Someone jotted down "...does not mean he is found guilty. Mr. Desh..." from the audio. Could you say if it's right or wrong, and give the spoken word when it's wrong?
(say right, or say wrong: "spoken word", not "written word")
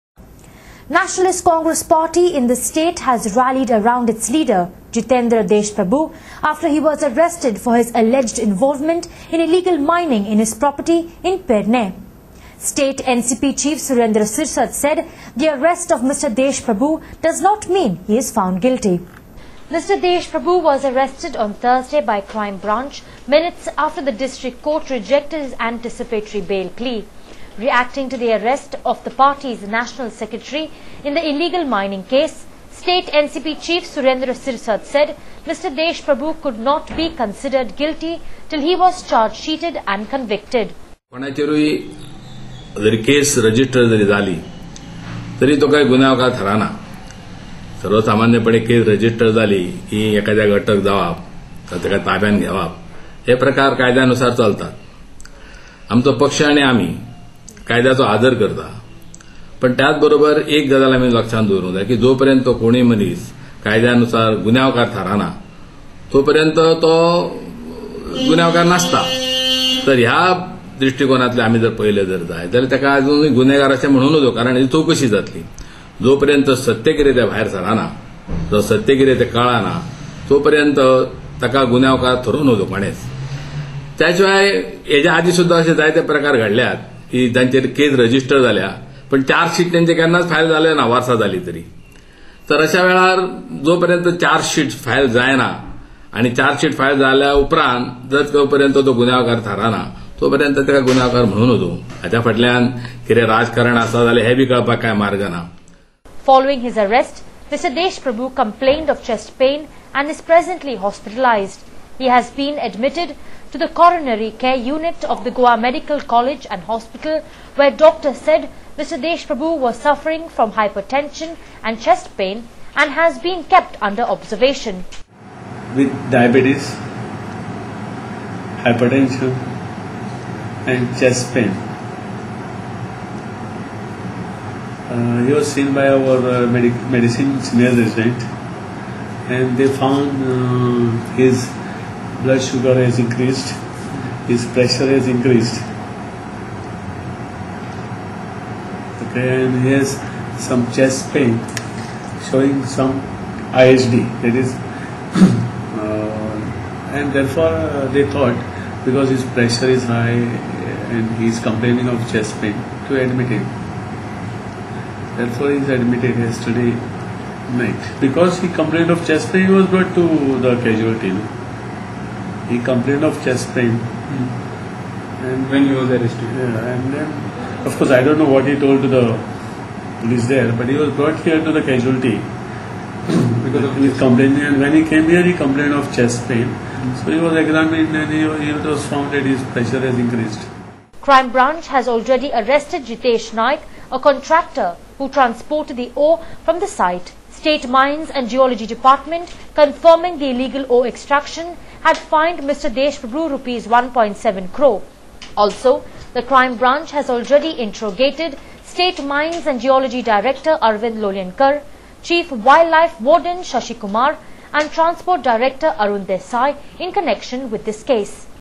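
right.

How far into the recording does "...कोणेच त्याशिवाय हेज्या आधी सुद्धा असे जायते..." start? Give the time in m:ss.
1:22.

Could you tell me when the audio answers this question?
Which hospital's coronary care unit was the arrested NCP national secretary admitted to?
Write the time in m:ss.
1:55.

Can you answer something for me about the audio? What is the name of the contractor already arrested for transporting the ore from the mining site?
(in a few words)
Jitesh Naik.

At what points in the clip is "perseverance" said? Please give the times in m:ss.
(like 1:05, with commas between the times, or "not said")
not said.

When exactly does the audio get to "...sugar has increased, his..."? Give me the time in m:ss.
2:22.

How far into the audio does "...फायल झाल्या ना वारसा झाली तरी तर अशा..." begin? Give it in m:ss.
1:30.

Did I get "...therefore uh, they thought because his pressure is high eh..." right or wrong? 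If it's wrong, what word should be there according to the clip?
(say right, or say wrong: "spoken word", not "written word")
right.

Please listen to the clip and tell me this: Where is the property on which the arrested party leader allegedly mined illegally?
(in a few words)
Pernem.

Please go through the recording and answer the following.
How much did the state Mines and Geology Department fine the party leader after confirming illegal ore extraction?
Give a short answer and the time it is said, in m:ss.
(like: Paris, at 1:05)
Rs 1.7 crore, at 3:23.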